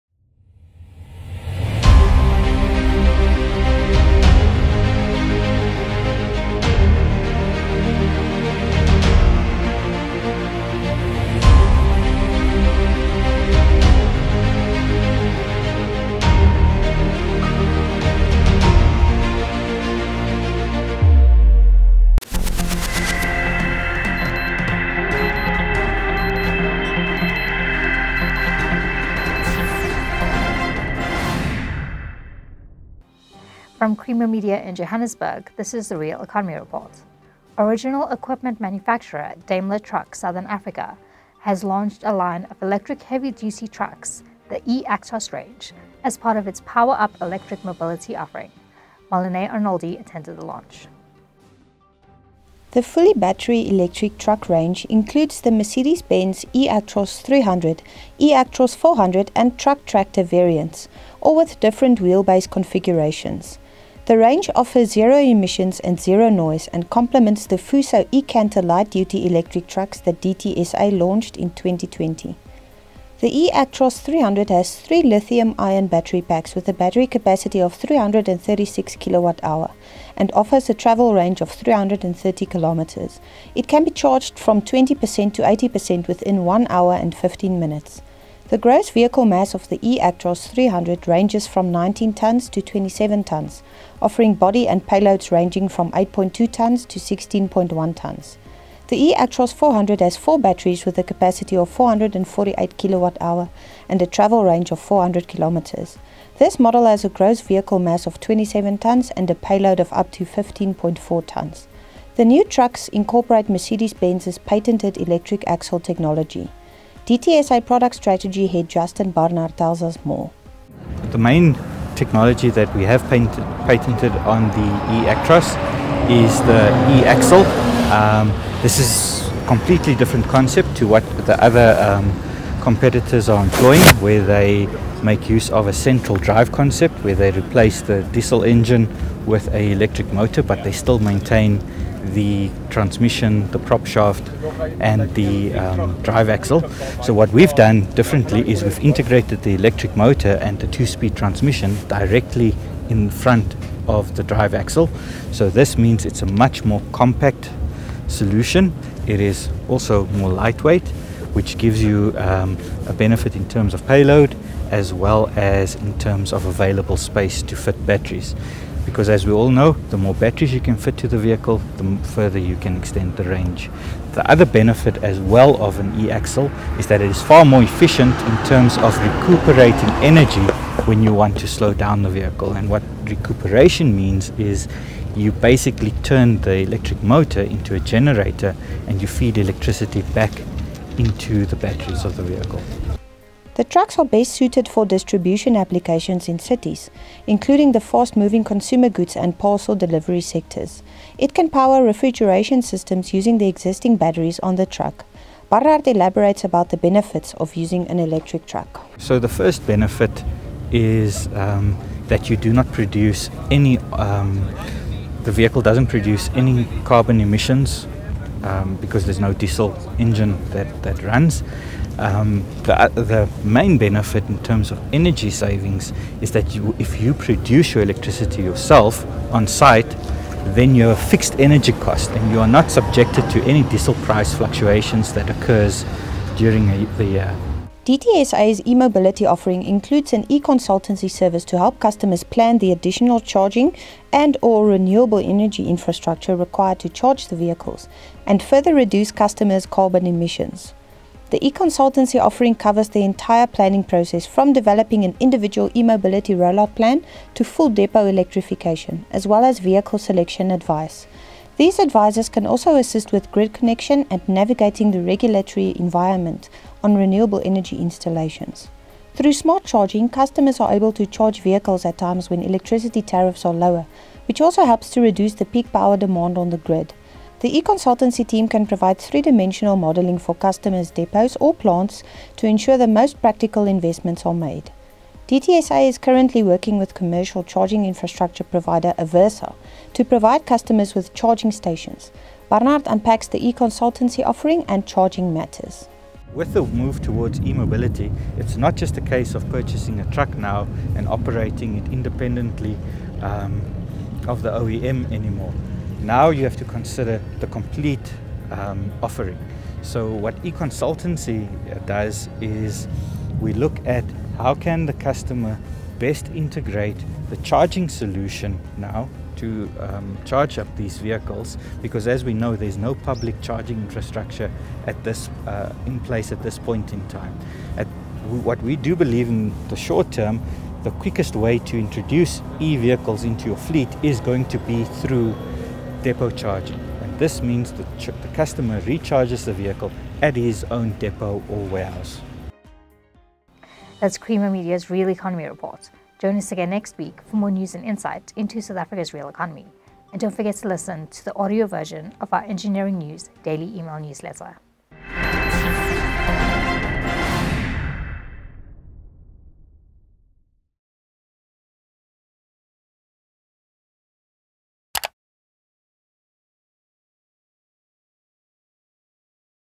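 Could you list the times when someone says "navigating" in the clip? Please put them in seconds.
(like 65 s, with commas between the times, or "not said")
264 s.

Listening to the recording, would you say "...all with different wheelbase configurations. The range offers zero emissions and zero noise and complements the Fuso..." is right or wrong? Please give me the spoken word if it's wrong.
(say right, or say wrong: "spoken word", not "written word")
right.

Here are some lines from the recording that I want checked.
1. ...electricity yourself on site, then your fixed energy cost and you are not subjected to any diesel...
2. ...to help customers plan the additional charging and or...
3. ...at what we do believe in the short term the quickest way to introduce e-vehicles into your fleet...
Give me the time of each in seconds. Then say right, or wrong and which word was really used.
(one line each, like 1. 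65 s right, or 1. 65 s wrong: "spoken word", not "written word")
1. 227 s right
2. 241 s right
3. 327 s right.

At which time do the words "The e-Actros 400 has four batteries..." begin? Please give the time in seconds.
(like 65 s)
98 s.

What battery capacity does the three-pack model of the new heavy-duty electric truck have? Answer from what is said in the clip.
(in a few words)
336 kWh.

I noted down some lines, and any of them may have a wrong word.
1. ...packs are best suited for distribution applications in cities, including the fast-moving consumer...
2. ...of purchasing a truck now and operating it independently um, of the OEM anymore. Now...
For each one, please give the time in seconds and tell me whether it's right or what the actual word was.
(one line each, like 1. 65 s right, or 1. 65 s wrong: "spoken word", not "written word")
1. 193 s wrong: "trucks", not "packs"
2. 299 s right.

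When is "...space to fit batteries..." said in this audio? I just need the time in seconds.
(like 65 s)
166 s.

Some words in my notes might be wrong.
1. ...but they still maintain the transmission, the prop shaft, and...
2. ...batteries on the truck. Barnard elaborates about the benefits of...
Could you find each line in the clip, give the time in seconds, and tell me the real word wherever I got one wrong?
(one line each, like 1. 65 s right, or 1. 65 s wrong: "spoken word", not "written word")
1. 140 s right
2. 203 s right.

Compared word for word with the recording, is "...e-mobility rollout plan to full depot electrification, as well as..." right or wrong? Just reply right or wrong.
right.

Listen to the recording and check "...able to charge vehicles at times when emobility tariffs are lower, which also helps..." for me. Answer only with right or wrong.
wrong.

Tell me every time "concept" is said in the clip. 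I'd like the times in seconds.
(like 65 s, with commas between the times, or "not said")
130 s, 136 s.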